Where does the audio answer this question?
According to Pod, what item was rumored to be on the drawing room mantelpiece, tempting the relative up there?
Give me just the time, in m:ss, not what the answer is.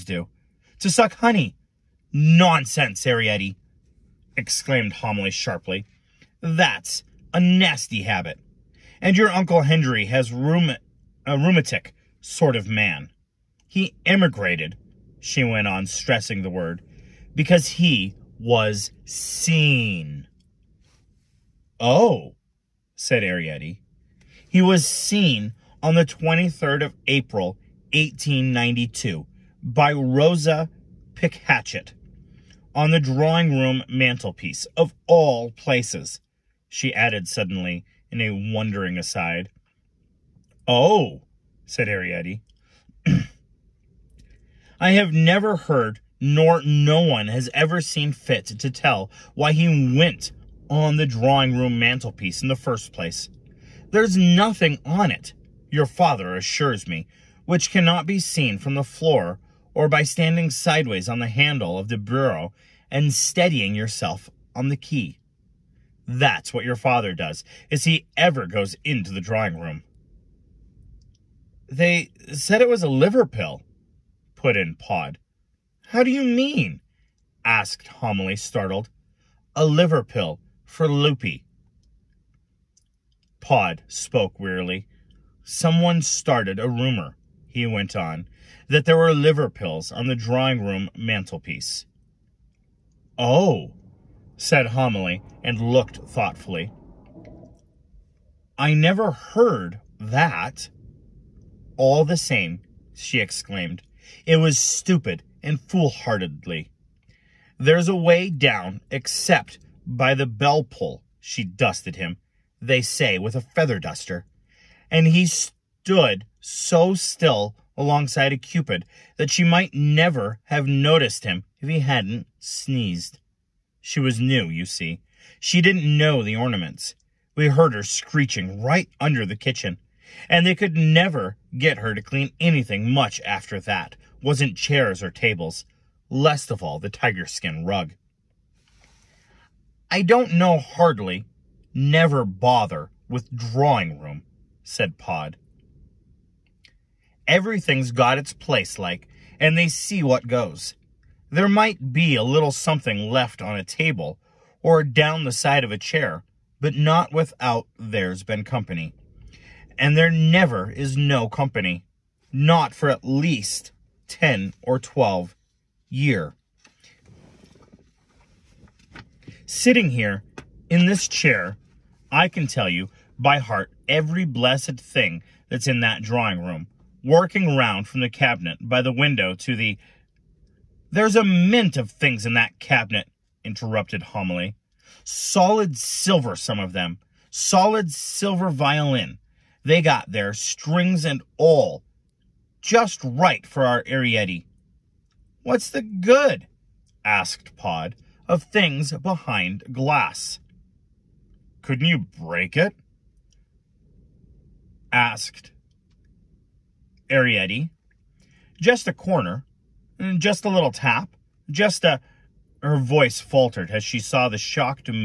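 1:29.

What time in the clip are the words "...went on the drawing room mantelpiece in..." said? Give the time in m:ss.
0:49.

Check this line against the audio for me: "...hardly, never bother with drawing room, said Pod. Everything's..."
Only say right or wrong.
right.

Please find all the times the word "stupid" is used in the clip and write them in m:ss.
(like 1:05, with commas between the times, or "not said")
1:44.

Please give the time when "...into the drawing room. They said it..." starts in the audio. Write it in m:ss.
1:08.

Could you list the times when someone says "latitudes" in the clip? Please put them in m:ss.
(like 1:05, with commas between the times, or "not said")
not said.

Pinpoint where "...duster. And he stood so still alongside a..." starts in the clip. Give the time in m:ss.
1:53.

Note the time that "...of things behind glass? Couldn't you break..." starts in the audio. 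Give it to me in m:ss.
3:18.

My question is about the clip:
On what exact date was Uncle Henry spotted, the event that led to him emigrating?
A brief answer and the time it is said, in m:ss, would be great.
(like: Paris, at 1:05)
23rd of April, 1892, at 0:26.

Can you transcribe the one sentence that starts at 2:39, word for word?
And there never is no company.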